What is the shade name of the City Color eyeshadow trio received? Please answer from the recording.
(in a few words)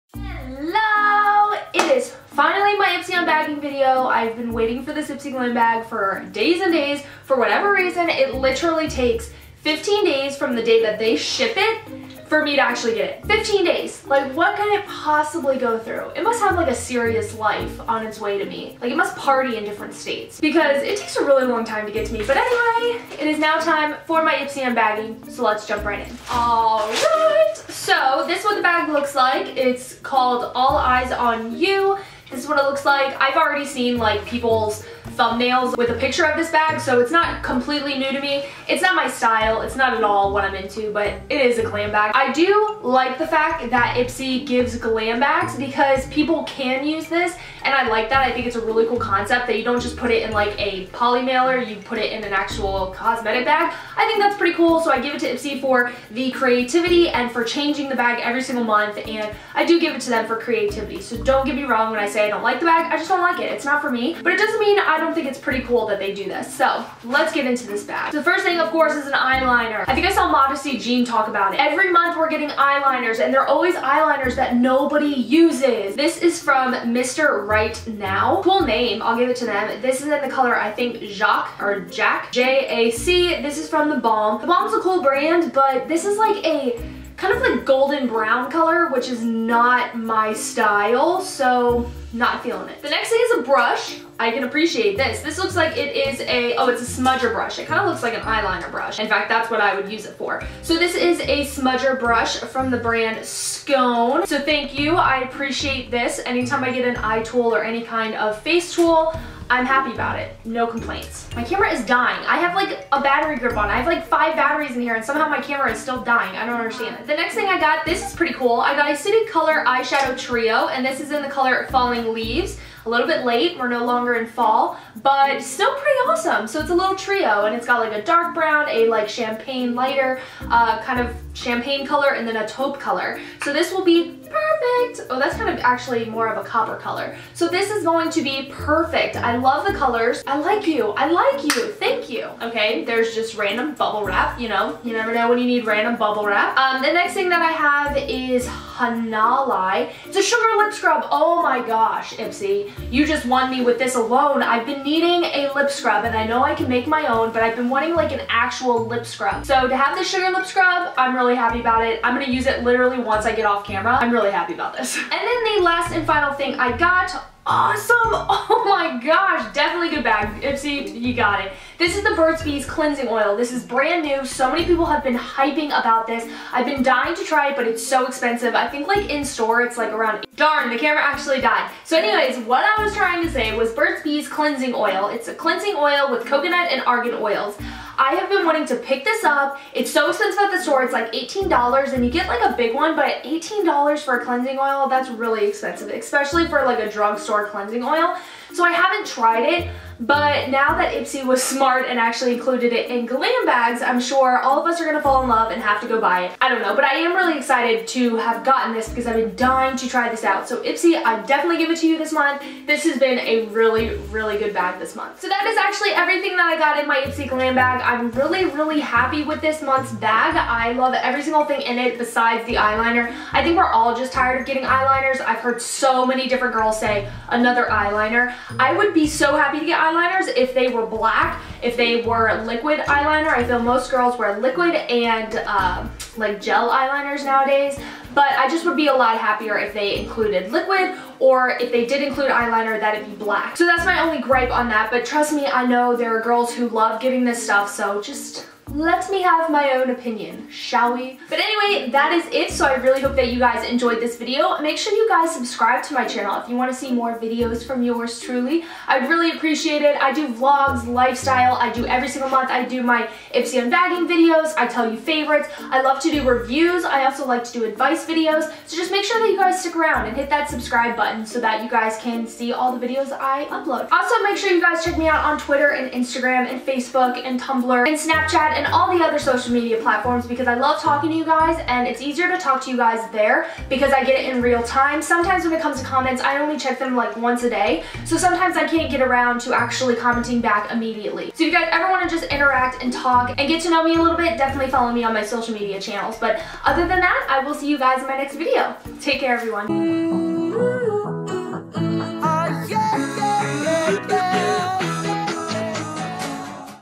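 Falling Leaves.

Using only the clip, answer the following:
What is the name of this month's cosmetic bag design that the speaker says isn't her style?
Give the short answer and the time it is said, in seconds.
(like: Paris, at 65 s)
All Eyes on You, at 30 s.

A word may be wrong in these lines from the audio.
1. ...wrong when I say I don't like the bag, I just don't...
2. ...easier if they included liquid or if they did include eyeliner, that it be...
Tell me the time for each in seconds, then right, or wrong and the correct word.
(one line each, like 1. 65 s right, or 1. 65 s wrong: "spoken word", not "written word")
1. 61 s right
2. 239 s wrong: "happier", not "easier".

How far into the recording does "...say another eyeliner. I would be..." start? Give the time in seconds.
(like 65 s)
226 s.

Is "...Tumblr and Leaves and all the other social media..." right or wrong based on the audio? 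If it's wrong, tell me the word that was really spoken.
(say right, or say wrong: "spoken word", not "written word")
wrong: "Snapchat", not "Leaves".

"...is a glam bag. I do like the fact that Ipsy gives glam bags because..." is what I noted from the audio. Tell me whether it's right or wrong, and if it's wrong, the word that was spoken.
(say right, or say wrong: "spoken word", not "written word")
right.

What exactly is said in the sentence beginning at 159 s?
So to have this sugar lip scrub, I'm really happy about it.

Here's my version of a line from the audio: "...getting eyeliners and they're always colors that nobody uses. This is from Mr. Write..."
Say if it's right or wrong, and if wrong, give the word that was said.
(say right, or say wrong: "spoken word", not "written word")
wrong: "eyeliners", not "colors".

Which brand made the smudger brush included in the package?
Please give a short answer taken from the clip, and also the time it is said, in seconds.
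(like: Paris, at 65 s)
Skone, at 103 s.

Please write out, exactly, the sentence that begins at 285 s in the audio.
Sometimes when it comes to comments, I only check them like once a day.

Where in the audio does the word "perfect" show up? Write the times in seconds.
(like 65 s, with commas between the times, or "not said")
134 s, 138 s.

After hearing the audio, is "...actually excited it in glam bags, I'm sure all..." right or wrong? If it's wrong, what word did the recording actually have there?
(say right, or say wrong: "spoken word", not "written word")
wrong: "included", not "excited".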